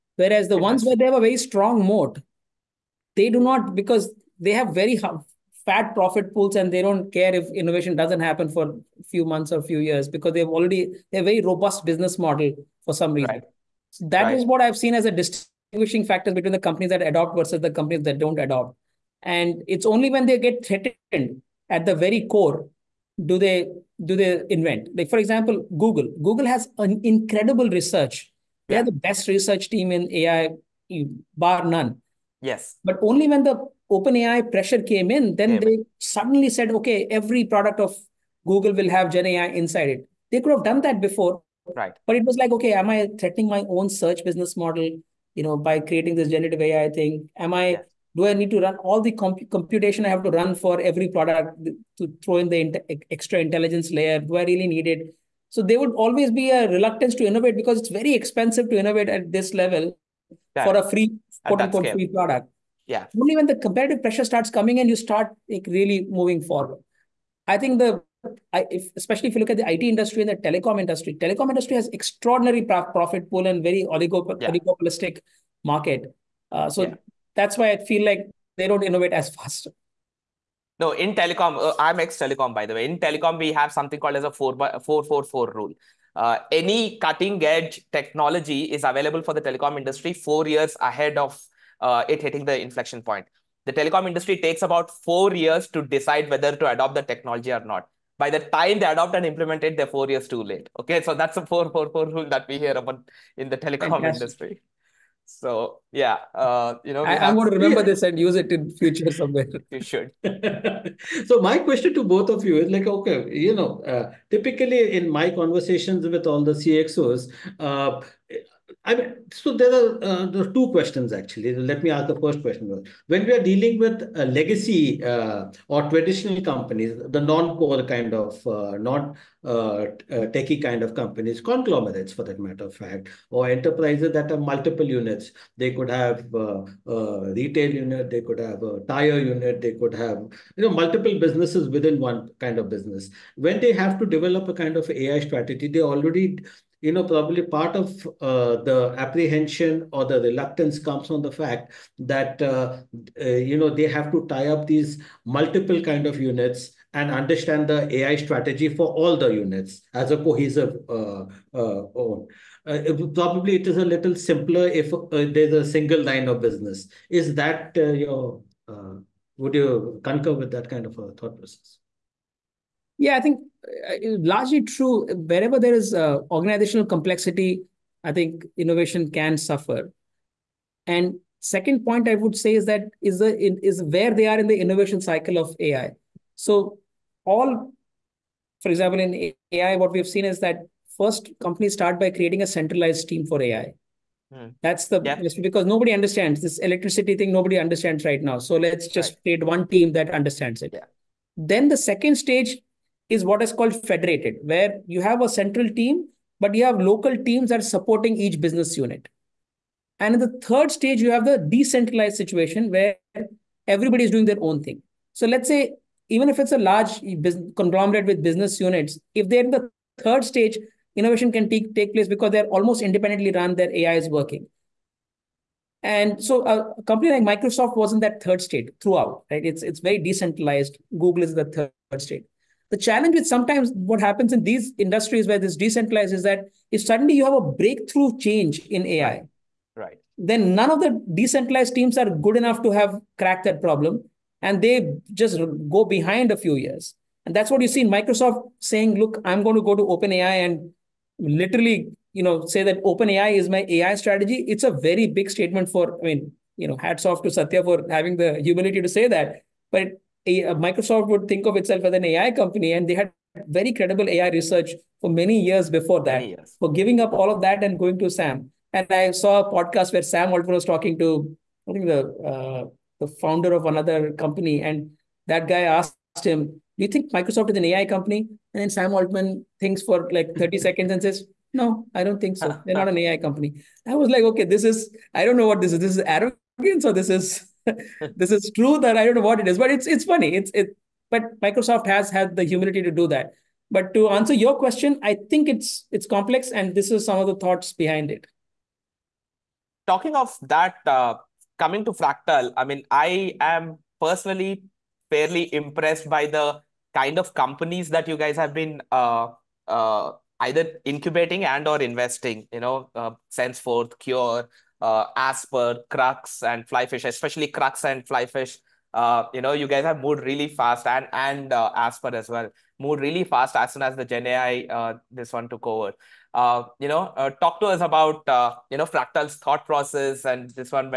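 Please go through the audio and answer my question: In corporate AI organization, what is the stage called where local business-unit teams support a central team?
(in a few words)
federated.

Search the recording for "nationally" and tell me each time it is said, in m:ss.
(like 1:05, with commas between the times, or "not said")
not said.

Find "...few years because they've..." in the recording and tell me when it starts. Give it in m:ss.
0:09.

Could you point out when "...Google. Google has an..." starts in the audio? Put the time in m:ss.
0:25.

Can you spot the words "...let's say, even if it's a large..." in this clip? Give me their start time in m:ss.
3:35.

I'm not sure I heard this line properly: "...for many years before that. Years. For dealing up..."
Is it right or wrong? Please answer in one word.
wrong.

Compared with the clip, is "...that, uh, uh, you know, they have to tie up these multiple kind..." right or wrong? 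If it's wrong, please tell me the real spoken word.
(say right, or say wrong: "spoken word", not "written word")
right.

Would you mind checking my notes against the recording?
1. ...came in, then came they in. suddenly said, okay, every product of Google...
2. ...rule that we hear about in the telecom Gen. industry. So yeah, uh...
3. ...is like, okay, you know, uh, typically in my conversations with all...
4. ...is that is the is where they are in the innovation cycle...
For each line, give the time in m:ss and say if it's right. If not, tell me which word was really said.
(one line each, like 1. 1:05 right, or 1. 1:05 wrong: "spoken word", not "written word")
1. 0:34 right
2. 1:42 wrong: "Fantastic", not "Gen"
3. 1:52 right
4. 3:02 right.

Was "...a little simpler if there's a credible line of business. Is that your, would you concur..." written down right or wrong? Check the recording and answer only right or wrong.
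wrong.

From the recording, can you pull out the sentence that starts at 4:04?
And they just go behind a few years.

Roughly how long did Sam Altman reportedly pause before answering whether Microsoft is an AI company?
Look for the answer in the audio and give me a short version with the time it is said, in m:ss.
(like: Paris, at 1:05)
30 seconds, at 4:40.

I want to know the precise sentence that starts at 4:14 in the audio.
It's a very big statement for, I mean, you know, hats off to Satya for having the humility to say that.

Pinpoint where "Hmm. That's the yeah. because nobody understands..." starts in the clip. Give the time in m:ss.
3:14.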